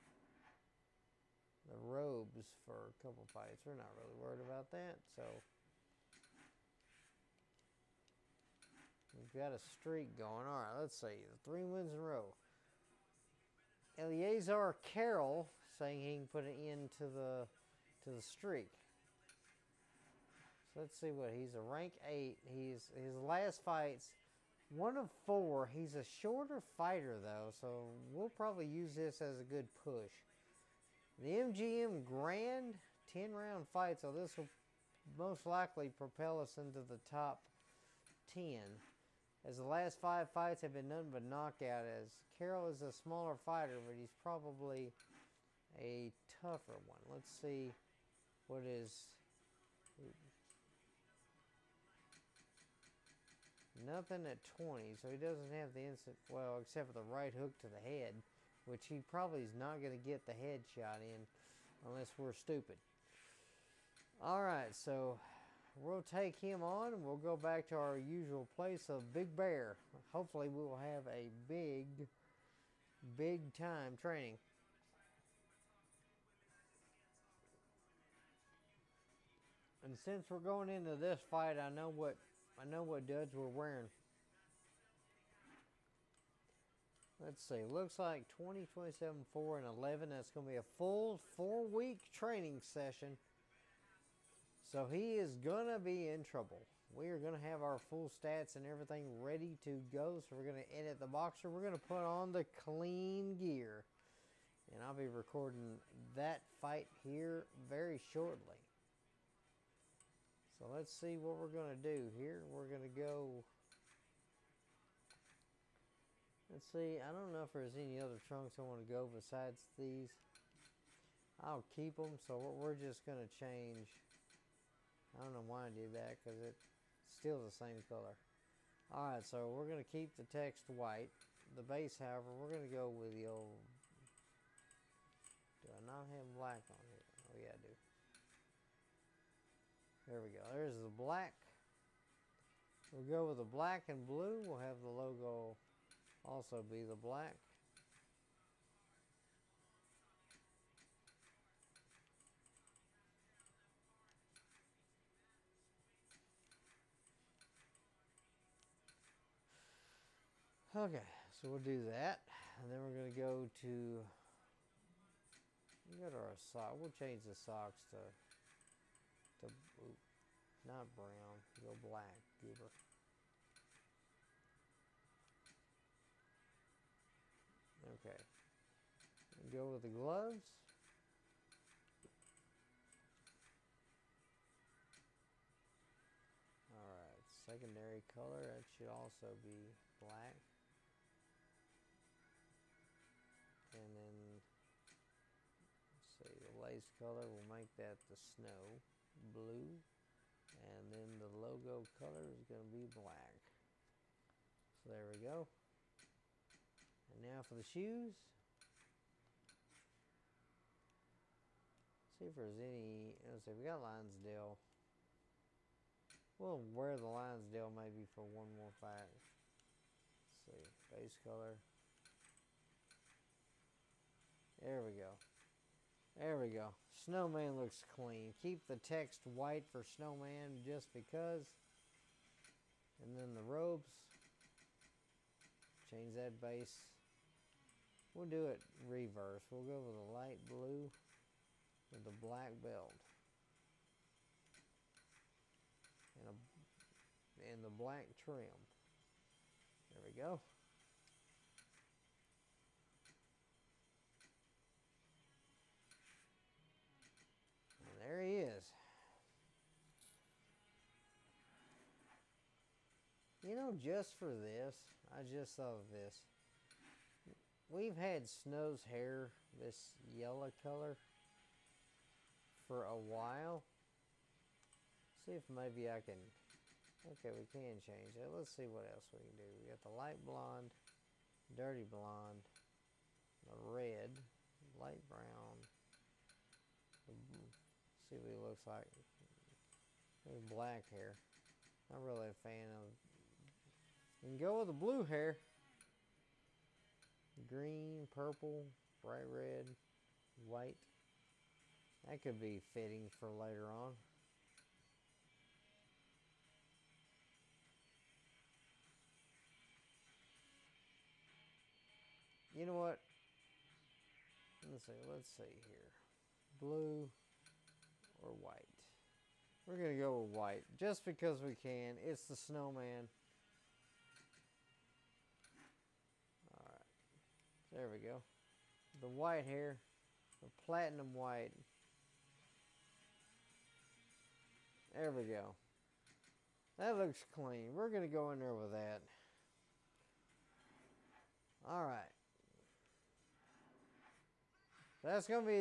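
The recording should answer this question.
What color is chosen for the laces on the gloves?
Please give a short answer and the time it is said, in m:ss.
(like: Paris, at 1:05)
snow blue, at 3:18.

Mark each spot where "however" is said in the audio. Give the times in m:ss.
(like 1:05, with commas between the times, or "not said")
2:11.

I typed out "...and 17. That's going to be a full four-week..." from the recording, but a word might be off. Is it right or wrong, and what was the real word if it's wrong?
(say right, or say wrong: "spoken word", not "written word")
wrong: "11", not "17".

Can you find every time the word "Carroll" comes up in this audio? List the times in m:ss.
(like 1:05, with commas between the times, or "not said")
0:14, 0:42.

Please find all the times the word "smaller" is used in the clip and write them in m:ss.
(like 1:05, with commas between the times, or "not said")
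0:42.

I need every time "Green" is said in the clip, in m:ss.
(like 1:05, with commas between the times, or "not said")
4:57.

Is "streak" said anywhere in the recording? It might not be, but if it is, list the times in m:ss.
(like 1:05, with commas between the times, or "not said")
0:09, 0:18.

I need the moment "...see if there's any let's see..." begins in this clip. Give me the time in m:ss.
3:32.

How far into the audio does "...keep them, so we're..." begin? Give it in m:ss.
2:01.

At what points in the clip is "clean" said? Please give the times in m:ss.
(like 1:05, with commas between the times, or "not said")
1:42, 3:47, 5:37.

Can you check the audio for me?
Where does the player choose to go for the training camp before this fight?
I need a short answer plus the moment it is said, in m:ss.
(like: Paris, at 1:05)
Big Bear, at 1:09.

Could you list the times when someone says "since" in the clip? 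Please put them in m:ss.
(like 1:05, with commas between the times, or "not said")
1:19.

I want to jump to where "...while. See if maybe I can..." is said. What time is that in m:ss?
4:32.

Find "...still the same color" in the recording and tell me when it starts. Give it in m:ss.
2:07.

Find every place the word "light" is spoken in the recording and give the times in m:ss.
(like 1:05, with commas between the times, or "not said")
4:00, 4:39, 4:44.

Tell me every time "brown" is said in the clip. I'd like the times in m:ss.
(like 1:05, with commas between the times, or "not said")
2:50, 4:45.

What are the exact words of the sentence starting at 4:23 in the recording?
You know, just for this, I just thought of this.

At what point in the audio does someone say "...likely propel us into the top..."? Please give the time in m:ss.
0:35.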